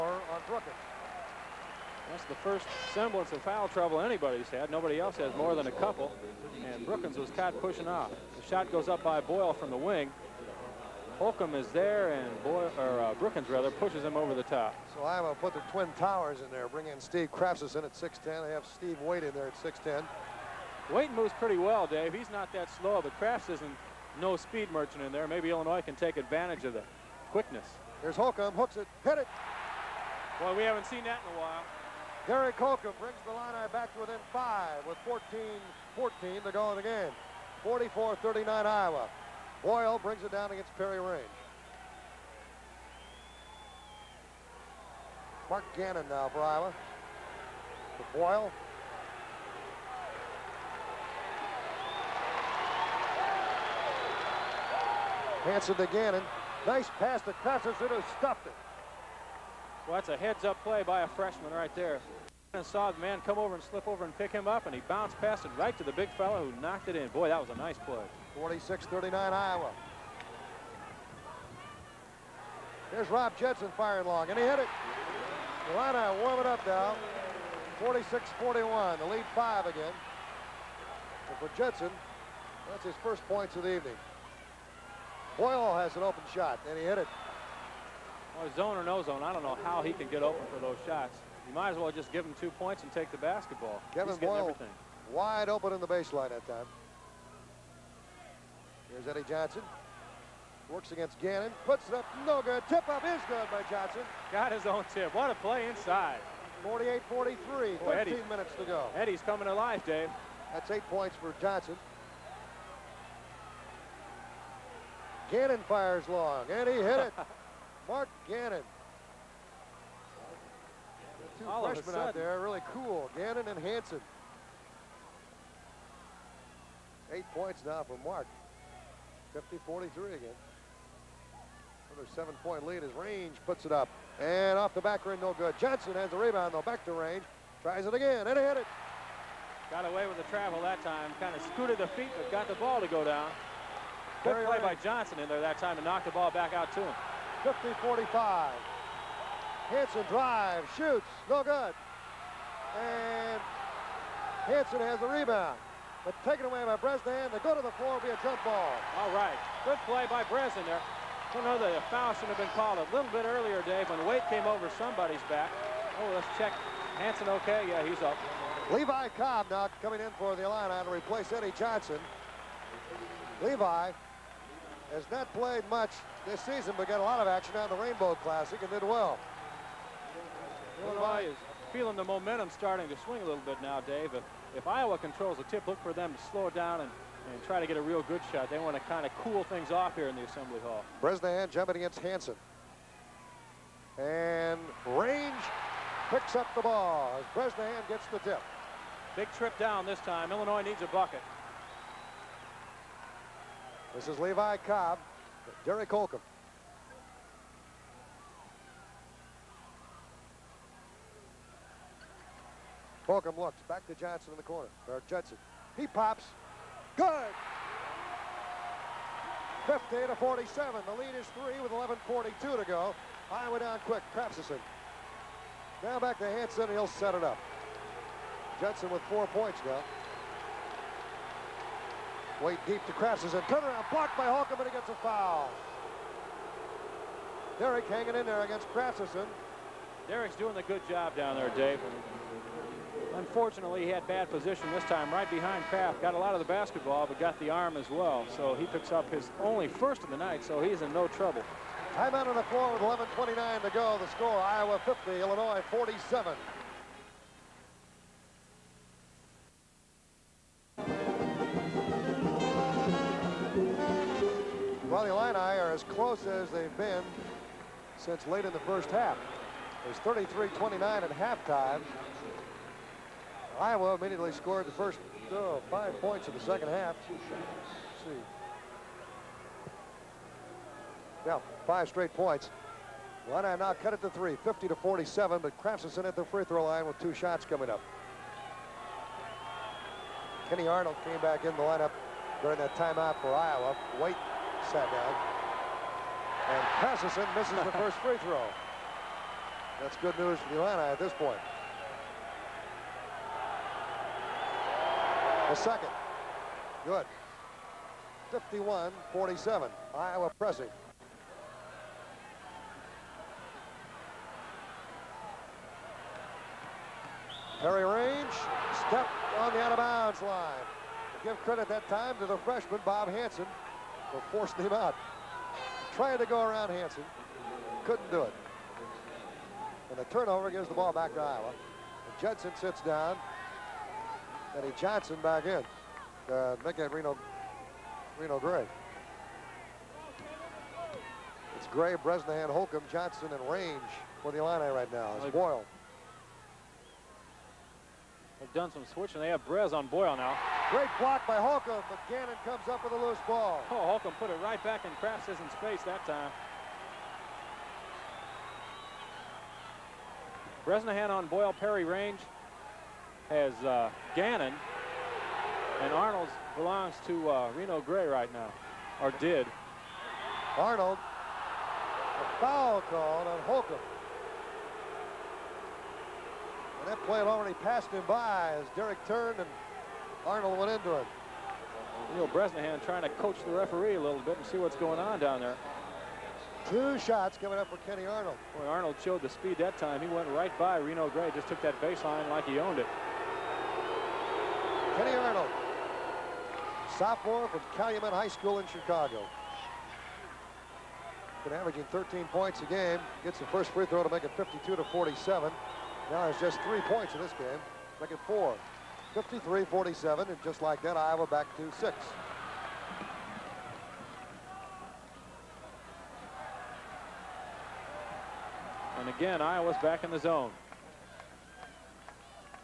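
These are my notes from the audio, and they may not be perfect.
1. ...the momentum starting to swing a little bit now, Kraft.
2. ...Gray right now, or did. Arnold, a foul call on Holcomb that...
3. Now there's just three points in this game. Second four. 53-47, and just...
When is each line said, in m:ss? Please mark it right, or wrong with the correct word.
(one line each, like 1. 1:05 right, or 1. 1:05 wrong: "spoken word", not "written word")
1. 3:01 wrong: "Dave", not "Kraft"
2. 6:07 right
3. 6:46 right.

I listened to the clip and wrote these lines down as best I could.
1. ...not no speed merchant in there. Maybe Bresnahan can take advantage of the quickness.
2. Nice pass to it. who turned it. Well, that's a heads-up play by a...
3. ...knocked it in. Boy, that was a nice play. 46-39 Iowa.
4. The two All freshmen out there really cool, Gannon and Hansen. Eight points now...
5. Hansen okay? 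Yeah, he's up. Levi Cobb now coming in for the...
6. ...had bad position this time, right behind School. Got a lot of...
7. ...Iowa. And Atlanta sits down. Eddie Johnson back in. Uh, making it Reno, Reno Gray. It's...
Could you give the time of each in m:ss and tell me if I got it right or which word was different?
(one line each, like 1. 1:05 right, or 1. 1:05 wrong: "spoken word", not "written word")
1. 0:23 wrong: "Illinois", not "Bresnahan"
2. 0:56 wrong: "stopped", not "turned"
3. 1:06 right
4. 2:01 right
5. 2:46 right
6. 4:03 wrong: "Kraft", not "School"
7. 5:31 wrong: "Judson", not "Atlanta".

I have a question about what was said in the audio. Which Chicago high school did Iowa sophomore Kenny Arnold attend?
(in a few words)
Calumet High School.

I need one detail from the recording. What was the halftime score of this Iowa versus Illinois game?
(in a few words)
33-29.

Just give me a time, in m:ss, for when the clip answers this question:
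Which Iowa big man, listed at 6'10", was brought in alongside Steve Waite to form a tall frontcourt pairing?
0:16.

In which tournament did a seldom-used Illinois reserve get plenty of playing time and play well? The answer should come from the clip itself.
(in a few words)
Rainbow Classic.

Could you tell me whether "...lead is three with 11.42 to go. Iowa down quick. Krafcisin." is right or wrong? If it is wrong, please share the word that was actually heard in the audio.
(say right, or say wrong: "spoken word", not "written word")
right.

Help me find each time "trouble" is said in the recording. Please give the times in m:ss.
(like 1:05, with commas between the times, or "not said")
0:03, 4:11.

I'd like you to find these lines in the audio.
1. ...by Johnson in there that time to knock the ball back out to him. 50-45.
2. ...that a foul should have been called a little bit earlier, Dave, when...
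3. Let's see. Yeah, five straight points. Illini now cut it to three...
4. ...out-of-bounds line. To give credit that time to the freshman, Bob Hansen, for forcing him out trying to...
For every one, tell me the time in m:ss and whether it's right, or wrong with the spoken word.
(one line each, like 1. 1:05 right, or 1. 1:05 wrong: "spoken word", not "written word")
1. 2:24 right
2. 2:41 right
3. 4:37 right
4. 5:19 right.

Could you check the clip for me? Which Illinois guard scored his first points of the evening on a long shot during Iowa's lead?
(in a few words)
Rob Judson.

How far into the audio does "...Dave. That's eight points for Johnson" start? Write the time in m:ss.
1:49.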